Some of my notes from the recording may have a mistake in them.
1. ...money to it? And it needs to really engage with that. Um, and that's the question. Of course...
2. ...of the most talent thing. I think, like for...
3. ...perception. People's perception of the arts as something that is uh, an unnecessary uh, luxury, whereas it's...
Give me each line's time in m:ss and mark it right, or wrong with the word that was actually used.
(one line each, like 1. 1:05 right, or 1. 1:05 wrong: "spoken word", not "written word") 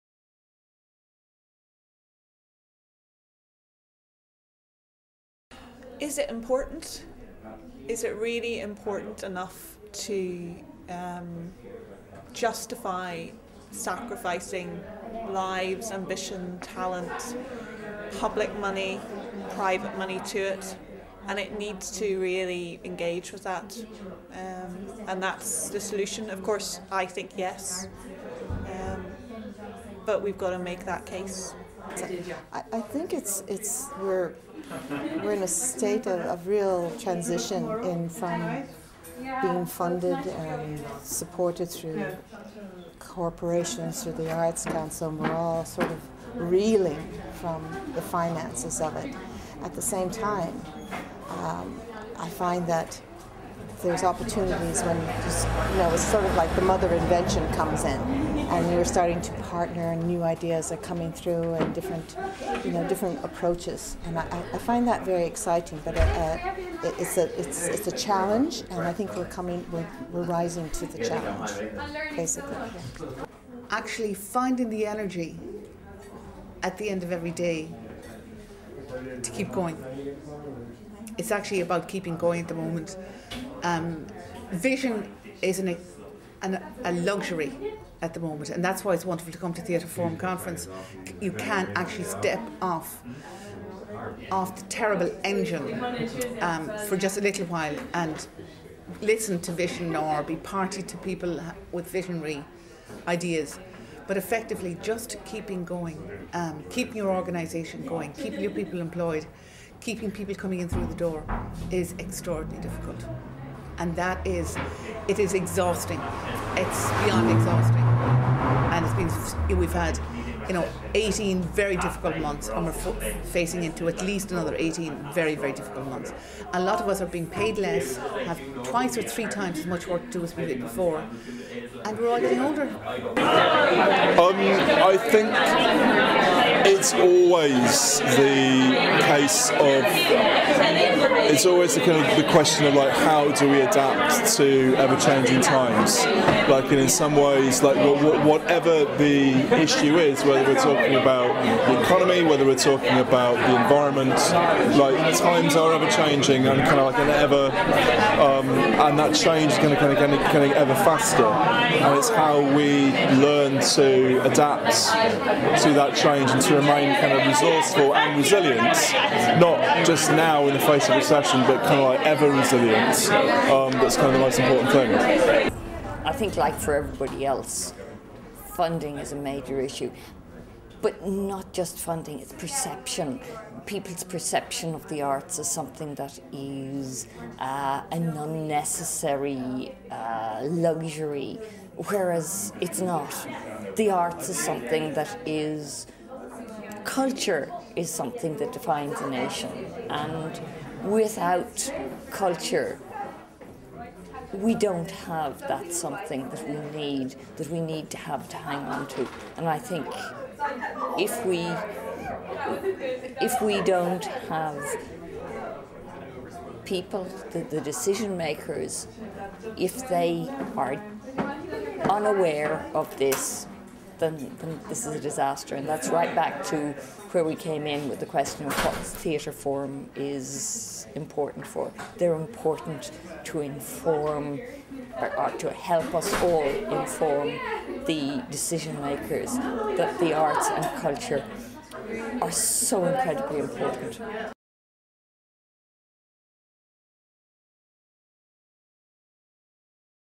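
1. 0:19 wrong: "solution", not "question"
2. 2:54 wrong: "important", not "talent"
3. 3:02 right.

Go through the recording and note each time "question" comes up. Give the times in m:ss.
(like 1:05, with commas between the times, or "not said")
2:22, 3:48.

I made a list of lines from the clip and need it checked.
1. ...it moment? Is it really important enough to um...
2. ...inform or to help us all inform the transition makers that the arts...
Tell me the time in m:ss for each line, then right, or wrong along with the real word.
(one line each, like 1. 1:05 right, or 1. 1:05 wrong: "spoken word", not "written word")
1. 0:06 wrong: "important", not "moment"
2. 3:53 wrong: "decision", not "transition".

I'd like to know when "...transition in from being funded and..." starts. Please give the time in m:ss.
0:36.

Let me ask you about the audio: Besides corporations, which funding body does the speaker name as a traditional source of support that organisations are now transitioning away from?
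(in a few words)
Arts Council.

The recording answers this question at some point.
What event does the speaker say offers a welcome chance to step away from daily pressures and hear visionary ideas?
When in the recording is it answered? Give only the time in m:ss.
1:29.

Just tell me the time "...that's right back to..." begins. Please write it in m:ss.
3:45.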